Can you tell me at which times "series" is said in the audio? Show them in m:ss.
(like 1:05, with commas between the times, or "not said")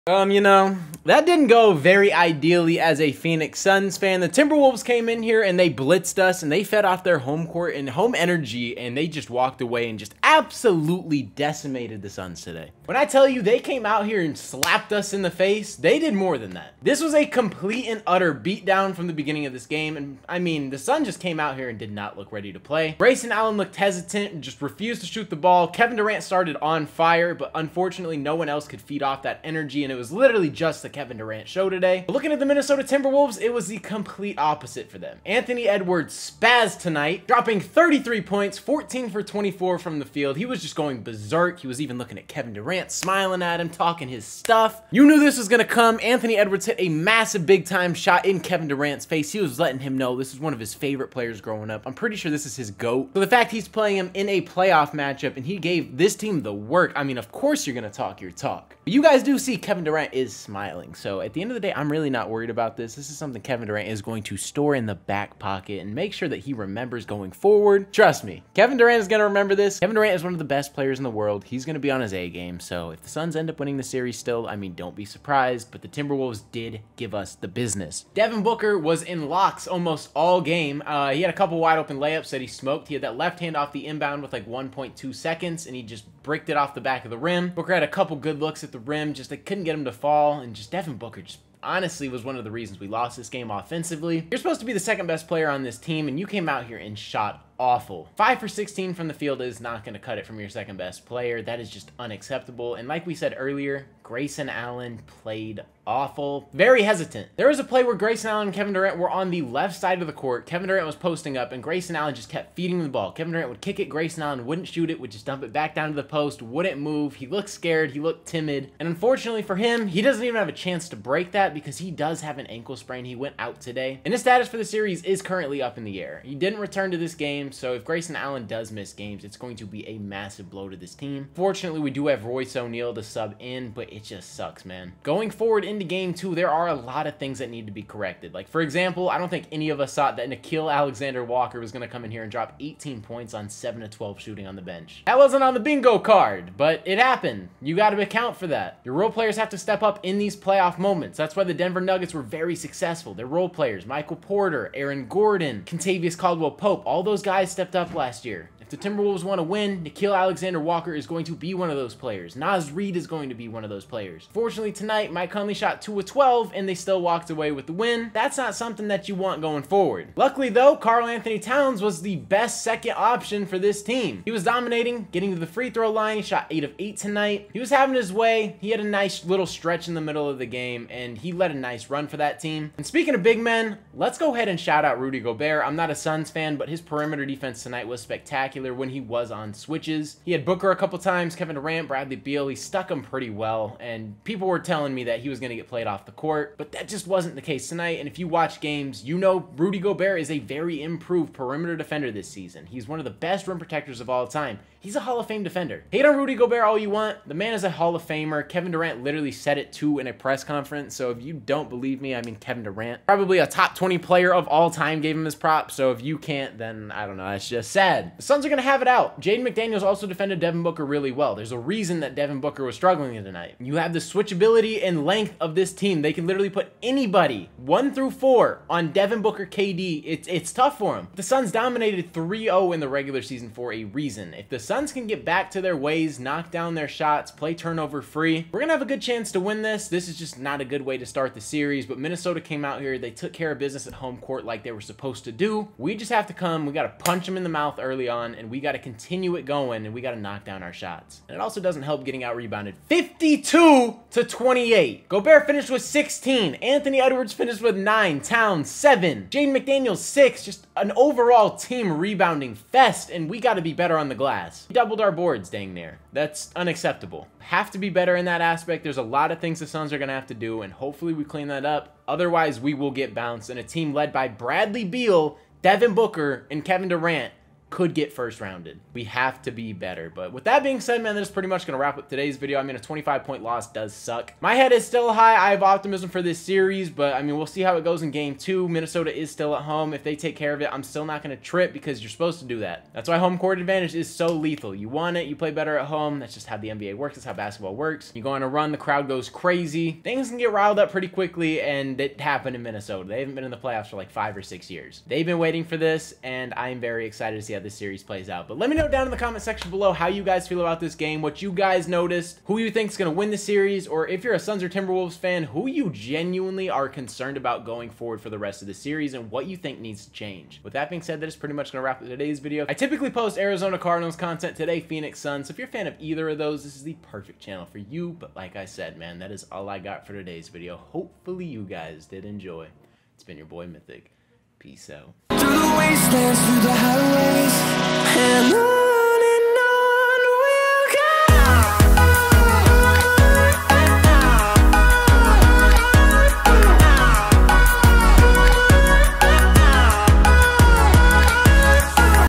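1:13, 2:04, 4:01, 4:46, 5:07, 5:13, 5:18.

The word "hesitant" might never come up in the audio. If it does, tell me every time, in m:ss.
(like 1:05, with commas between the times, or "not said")
0:23, 1:46.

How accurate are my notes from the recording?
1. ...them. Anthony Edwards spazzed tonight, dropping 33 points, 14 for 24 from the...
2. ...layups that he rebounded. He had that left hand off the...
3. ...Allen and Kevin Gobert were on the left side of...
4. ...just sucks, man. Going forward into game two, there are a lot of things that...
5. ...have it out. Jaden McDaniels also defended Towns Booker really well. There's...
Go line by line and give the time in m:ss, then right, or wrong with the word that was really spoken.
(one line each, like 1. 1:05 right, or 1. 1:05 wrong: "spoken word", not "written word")
1. 0:34 right
2. 1:21 wrong: "smoked", not "rebounded"
3. 1:48 wrong: "Durant", not "Gobert"
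4. 2:14 right
5. 3:38 wrong: "Devin", not "Towns".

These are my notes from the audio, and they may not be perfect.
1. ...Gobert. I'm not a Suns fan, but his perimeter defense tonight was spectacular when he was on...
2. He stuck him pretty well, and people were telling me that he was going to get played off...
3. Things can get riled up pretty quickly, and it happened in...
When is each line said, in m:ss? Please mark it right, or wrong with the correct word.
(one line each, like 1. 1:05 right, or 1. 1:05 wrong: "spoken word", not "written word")
1. 3:05 right
2. 3:12 right
3. 5:00 right.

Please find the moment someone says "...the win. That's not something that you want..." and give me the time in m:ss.
2:47.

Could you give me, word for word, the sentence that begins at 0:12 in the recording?
When I tell you they came out here and slapped us in the face, they did more than that.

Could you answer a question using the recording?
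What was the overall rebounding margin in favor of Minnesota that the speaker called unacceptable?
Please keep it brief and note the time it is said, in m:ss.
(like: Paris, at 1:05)
52 to 28, at 4:12.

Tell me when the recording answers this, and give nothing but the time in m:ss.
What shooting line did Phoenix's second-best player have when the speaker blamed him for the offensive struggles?
1:38.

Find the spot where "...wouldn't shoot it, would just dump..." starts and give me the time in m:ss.
1:54.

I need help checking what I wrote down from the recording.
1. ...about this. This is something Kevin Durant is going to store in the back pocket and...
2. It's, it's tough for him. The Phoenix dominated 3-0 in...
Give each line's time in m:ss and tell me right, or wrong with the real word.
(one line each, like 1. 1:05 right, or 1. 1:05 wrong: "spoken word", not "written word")
1. 1:02 right
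2. 3:50 wrong: "Suns", not "Phoenix".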